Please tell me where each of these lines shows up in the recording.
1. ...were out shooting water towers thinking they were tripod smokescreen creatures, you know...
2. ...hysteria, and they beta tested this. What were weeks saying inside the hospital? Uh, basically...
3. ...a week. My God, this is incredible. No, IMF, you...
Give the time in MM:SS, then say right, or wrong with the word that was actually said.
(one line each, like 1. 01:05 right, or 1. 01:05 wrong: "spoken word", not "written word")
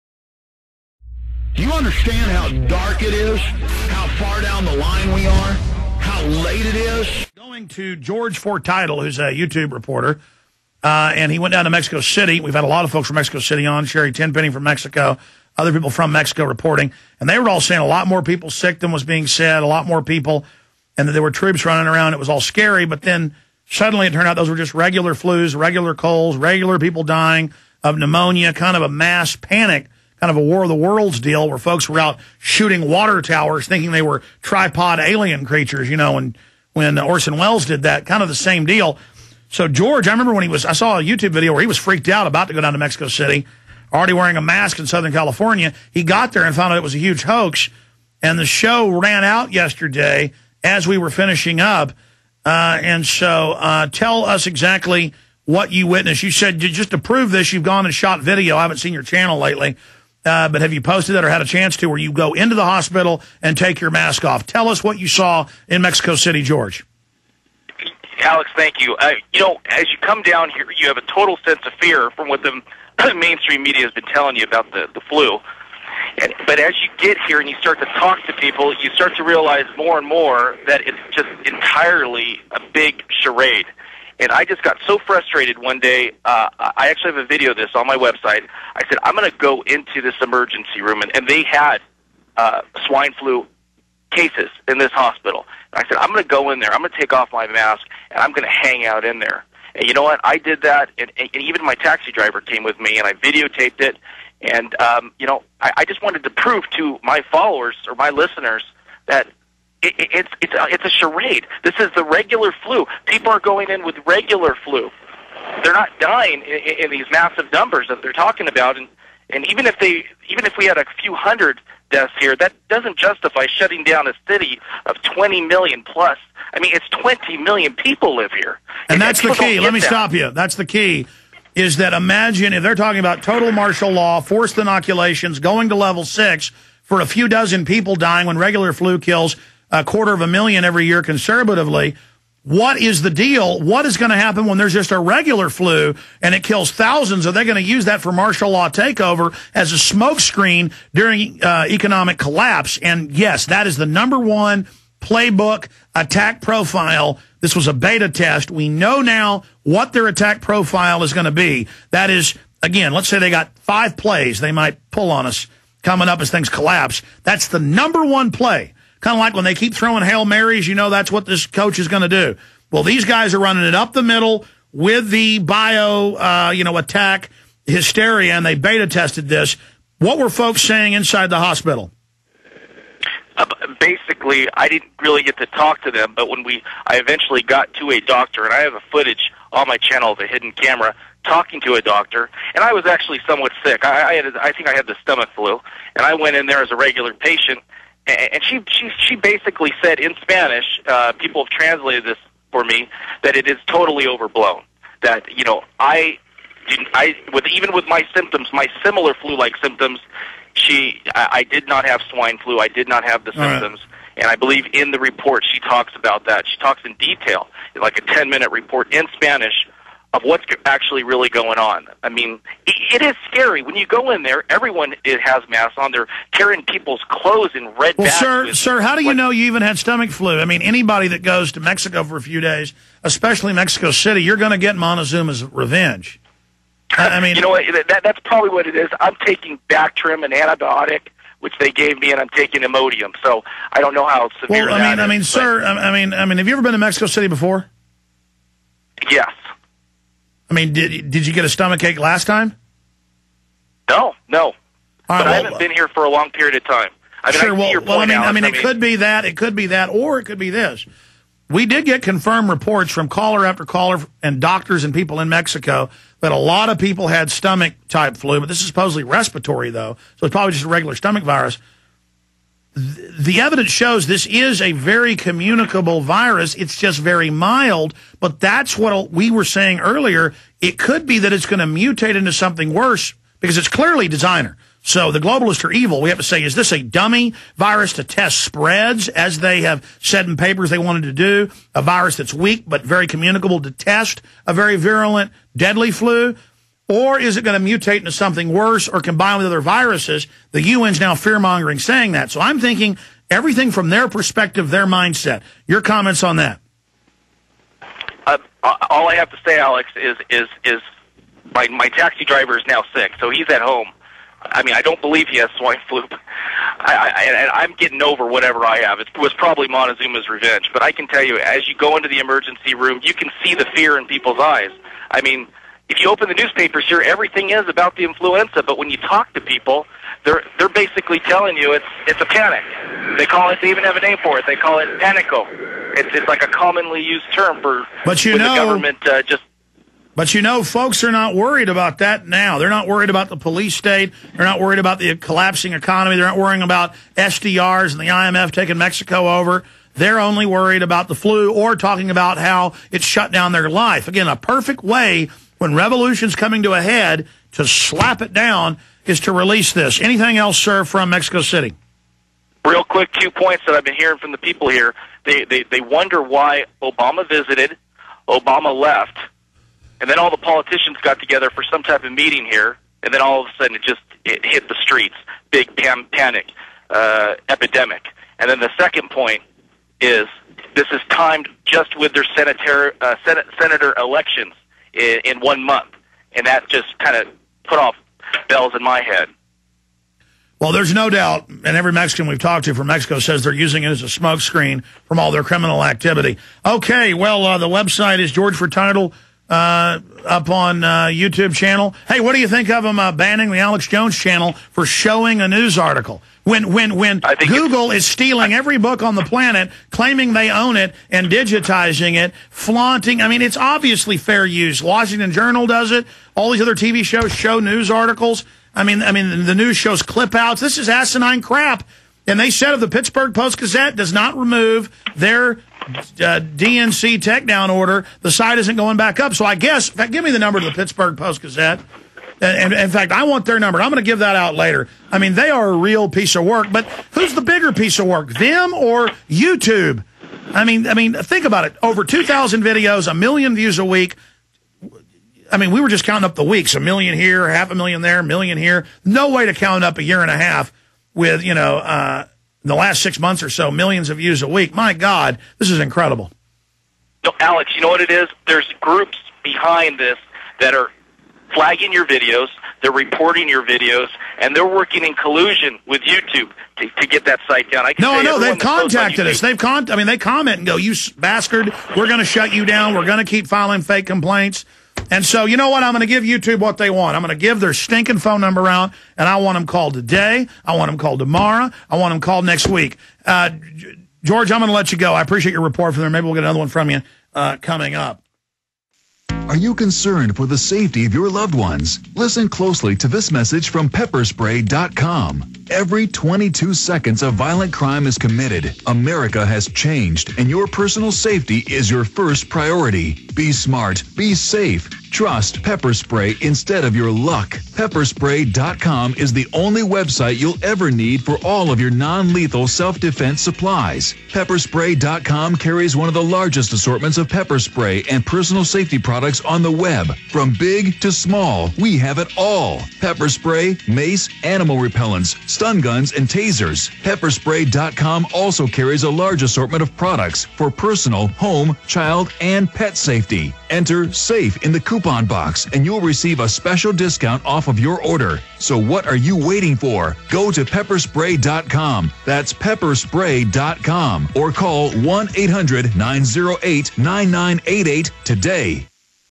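1. 00:31 wrong: "alien", not "smokescreen"
2. 02:57 wrong: "folks", not "weeks"
3. 07:34 wrong: "Alex", not "IMF".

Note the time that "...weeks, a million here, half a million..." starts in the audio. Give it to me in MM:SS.
07:26.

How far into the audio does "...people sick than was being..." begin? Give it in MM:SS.
00:18.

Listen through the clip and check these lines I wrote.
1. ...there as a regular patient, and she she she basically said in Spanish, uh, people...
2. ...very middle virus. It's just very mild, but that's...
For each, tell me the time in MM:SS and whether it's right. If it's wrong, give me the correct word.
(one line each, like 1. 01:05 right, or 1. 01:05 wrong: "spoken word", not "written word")
1. 03:16 right
2. 04:34 wrong: "communicable", not "middle".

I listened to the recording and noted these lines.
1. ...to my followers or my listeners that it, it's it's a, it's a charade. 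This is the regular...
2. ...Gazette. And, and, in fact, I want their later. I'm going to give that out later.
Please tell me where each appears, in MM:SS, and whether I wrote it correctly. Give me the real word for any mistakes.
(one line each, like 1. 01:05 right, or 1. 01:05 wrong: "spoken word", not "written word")
1. 01:46 right
2. 07:11 wrong: "number", not "later".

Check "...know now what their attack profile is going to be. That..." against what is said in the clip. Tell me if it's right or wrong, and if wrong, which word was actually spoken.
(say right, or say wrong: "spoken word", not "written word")
right.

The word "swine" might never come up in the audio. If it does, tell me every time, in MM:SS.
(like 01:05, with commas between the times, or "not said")
01:32, 03:32, 05:15.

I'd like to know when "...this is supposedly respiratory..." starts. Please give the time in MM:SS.
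04:28.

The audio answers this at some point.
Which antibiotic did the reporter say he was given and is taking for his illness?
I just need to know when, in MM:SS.
03:59.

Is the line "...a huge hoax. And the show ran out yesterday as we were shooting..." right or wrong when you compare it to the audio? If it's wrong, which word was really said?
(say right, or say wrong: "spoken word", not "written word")
wrong: "finishing", not "shooting".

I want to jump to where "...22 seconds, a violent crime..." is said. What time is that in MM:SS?
08:16.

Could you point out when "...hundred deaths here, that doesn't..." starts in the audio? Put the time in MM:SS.
02:01.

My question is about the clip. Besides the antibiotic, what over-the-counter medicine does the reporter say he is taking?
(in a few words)
Imodium.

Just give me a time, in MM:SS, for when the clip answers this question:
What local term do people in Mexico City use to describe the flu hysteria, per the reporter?
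05:35.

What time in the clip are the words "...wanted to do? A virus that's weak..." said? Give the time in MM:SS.
04:50.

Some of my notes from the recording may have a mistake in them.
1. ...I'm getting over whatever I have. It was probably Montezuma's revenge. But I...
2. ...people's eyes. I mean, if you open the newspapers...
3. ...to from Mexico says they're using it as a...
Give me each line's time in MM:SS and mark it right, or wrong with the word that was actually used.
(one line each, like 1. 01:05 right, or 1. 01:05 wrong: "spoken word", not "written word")
1. 05:17 right
2. 05:24 right
3. 06:32 right.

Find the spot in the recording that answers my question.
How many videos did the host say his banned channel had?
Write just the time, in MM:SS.
07:21.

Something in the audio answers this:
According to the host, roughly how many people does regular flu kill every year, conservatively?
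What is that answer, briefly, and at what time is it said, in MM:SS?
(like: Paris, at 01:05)
a quarter of a million, at 02:19.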